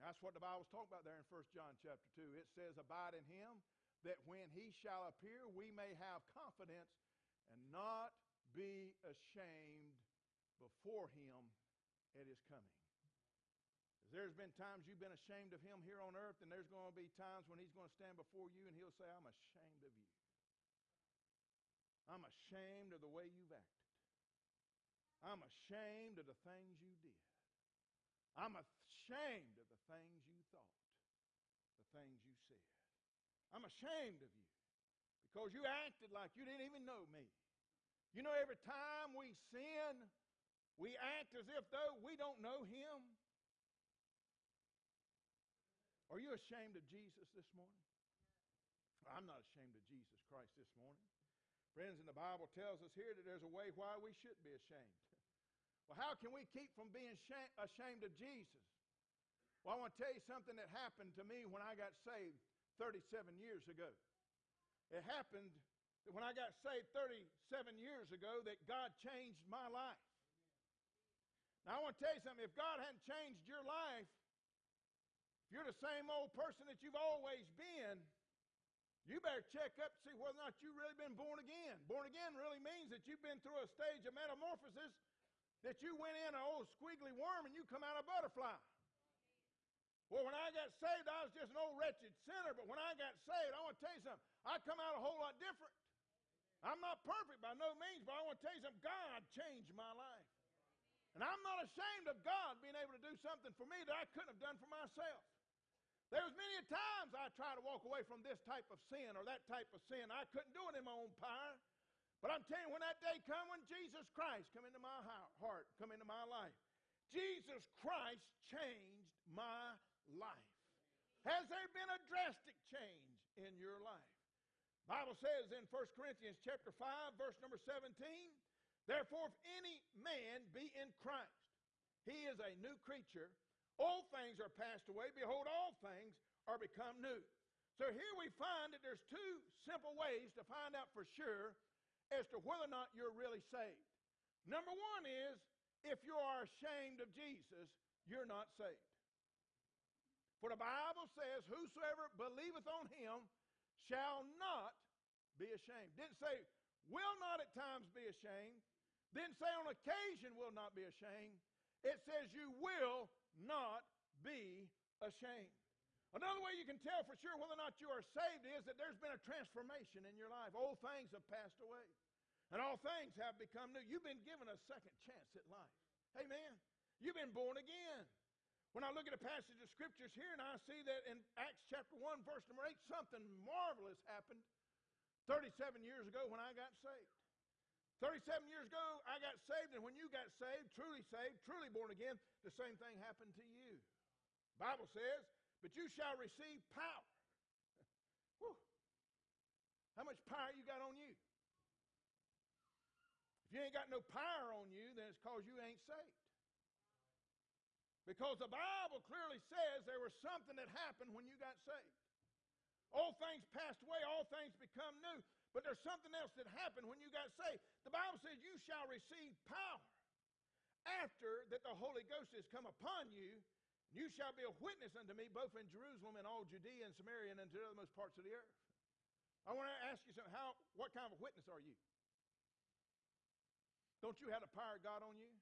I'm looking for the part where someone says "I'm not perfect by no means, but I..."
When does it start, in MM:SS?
01:36.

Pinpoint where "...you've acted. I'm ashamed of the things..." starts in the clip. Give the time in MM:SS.
00:23.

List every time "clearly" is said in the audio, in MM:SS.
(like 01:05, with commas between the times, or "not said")
03:29.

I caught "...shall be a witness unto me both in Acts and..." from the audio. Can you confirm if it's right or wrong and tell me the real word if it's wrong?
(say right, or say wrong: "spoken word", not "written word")
wrong: "Jerusalem", not "Acts".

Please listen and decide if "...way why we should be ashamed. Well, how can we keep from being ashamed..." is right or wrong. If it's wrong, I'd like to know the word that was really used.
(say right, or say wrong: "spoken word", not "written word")
right.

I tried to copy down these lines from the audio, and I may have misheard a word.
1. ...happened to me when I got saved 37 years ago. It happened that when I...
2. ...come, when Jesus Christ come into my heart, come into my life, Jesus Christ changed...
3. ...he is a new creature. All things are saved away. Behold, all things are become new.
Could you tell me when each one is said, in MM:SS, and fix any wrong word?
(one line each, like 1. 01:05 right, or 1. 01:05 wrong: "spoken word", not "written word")
1. 01:00 right
2. 01:53 right
3. 02:12 wrong: "passed", not "saved".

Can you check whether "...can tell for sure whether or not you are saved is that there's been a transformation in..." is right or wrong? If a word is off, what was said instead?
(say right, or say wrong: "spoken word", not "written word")
right.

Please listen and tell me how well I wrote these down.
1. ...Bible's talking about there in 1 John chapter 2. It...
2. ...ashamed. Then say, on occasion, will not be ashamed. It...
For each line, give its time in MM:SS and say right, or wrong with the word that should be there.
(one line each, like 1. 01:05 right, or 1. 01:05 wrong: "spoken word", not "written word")
1. 00:00 right
2. 02:38 right.